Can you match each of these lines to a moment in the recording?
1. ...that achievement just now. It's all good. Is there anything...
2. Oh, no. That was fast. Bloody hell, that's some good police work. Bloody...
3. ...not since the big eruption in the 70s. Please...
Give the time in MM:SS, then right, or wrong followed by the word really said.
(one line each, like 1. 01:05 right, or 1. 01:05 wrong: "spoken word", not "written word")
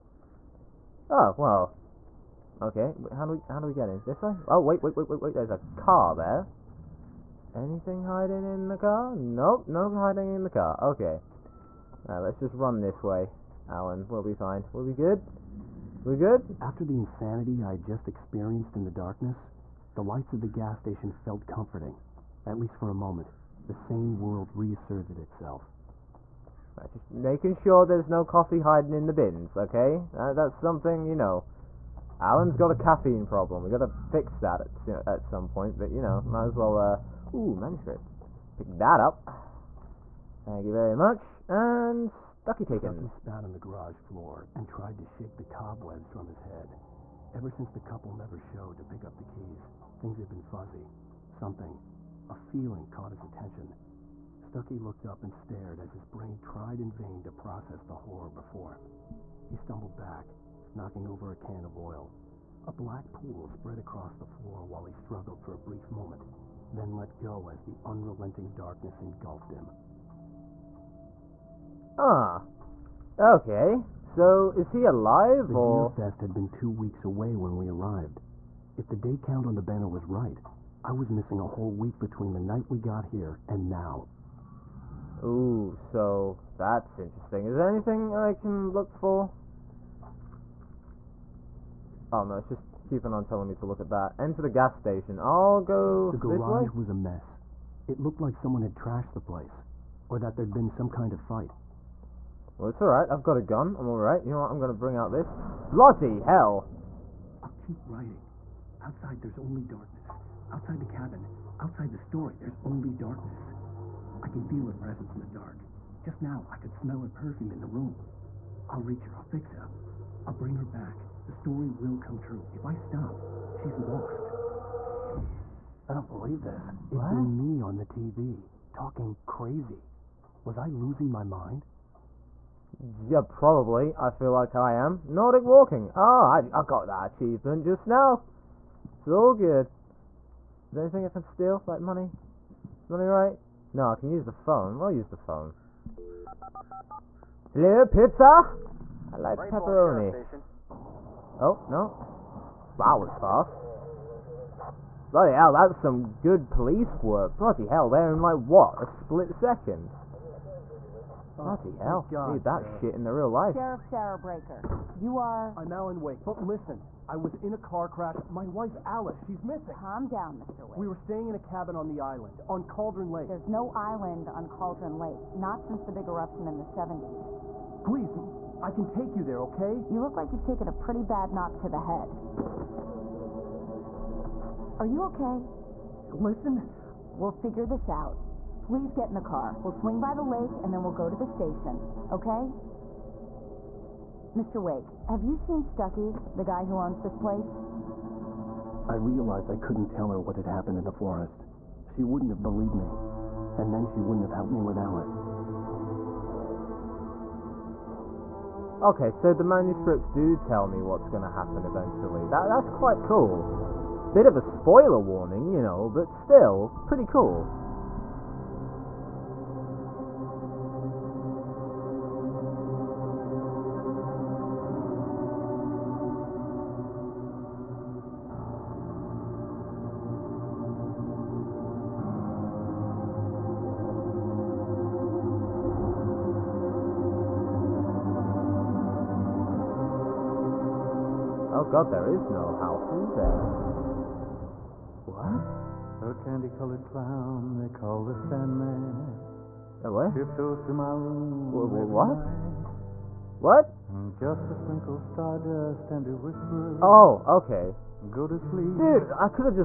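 1. 02:16 right
2. 02:31 right
3. 02:55 right.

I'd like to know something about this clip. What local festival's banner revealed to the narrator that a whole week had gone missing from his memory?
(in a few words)
Deerfest.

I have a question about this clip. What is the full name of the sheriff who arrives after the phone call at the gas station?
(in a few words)
Sarah Breaker.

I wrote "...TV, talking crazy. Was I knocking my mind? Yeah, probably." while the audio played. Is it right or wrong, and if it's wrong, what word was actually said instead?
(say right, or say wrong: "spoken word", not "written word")
wrong: "losing", not "knocking".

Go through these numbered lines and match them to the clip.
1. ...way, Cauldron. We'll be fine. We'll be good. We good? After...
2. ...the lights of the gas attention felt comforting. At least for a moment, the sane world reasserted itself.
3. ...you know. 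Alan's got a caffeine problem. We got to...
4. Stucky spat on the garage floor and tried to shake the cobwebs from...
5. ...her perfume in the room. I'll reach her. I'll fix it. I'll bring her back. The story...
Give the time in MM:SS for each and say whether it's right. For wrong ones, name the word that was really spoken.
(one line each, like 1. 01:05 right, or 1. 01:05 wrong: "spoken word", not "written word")
1. 00:13 wrong: "Alan", not "Cauldron"
2. 00:19 wrong: "station", not "attention"
3. 00:31 right
4. 00:42 right
5. 01:56 right.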